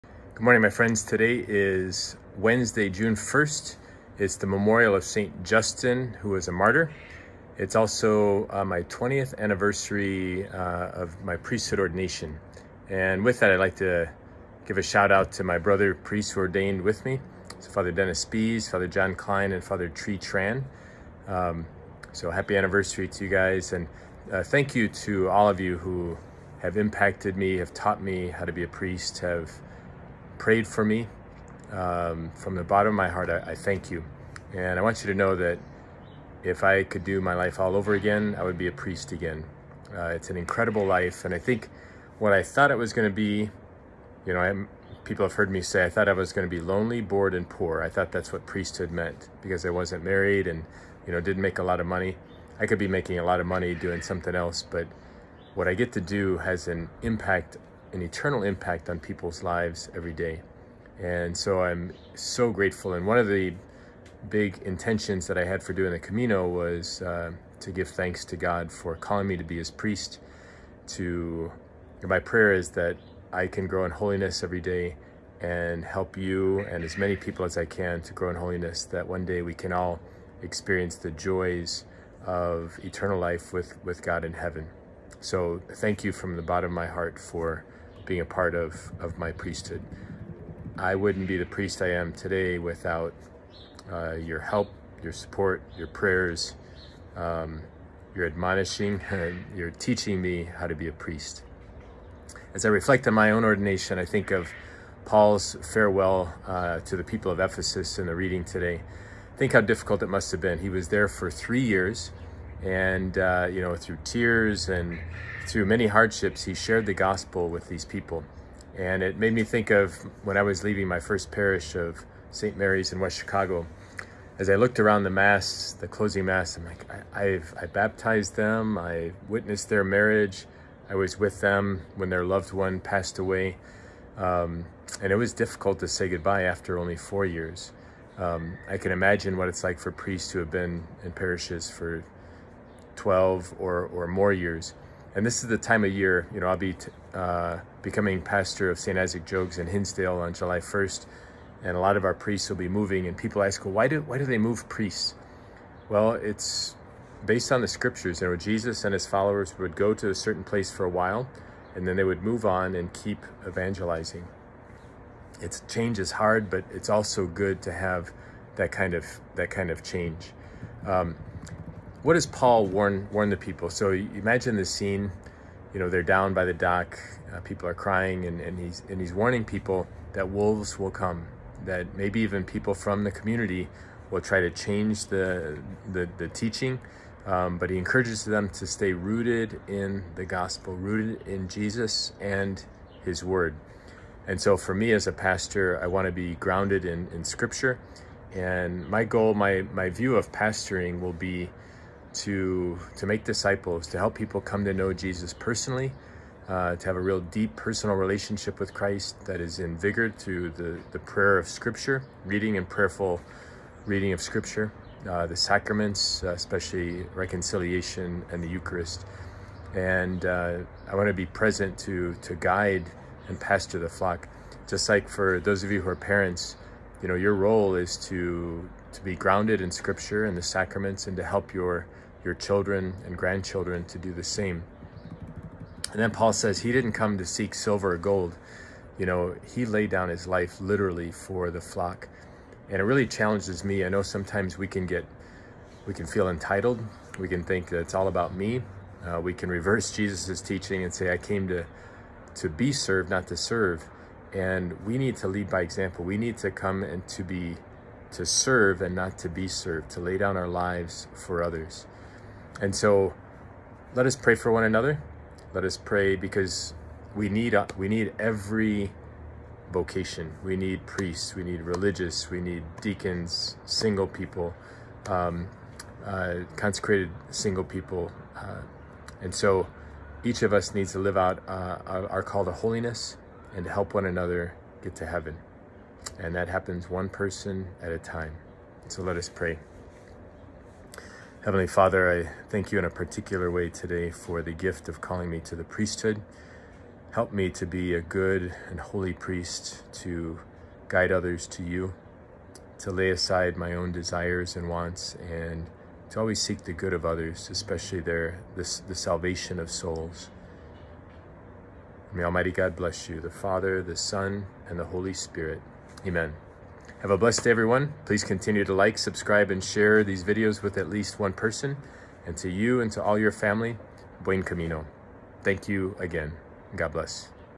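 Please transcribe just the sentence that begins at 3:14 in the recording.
And so for me as a pastor, I want to be grounded in, in scripture.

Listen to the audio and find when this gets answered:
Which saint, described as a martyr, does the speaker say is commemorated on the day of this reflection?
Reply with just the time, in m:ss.
0:05.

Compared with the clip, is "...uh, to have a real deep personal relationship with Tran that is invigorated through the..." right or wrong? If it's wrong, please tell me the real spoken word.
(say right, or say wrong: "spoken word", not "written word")
wrong: "Christ", not "Tran".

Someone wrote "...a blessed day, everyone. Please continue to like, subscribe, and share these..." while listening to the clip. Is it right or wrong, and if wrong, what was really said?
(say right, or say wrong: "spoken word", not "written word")
right.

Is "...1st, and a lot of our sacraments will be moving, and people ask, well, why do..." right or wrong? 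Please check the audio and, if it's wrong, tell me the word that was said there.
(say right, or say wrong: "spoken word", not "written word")
wrong: "priests", not "sacraments".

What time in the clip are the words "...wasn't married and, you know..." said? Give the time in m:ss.
0:49.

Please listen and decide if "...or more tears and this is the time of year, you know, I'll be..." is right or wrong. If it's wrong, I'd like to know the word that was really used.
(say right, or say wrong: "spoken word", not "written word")
wrong: "years", not "tears".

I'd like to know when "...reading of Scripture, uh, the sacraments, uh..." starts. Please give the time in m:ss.
3:33.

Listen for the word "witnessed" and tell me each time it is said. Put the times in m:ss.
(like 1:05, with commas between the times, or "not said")
2:09.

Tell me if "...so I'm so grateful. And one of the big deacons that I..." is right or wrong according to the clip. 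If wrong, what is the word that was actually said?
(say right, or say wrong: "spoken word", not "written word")
wrong: "intentions", not "deacons".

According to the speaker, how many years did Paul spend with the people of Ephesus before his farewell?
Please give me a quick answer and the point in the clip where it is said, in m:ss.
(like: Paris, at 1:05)
3, at 1:51.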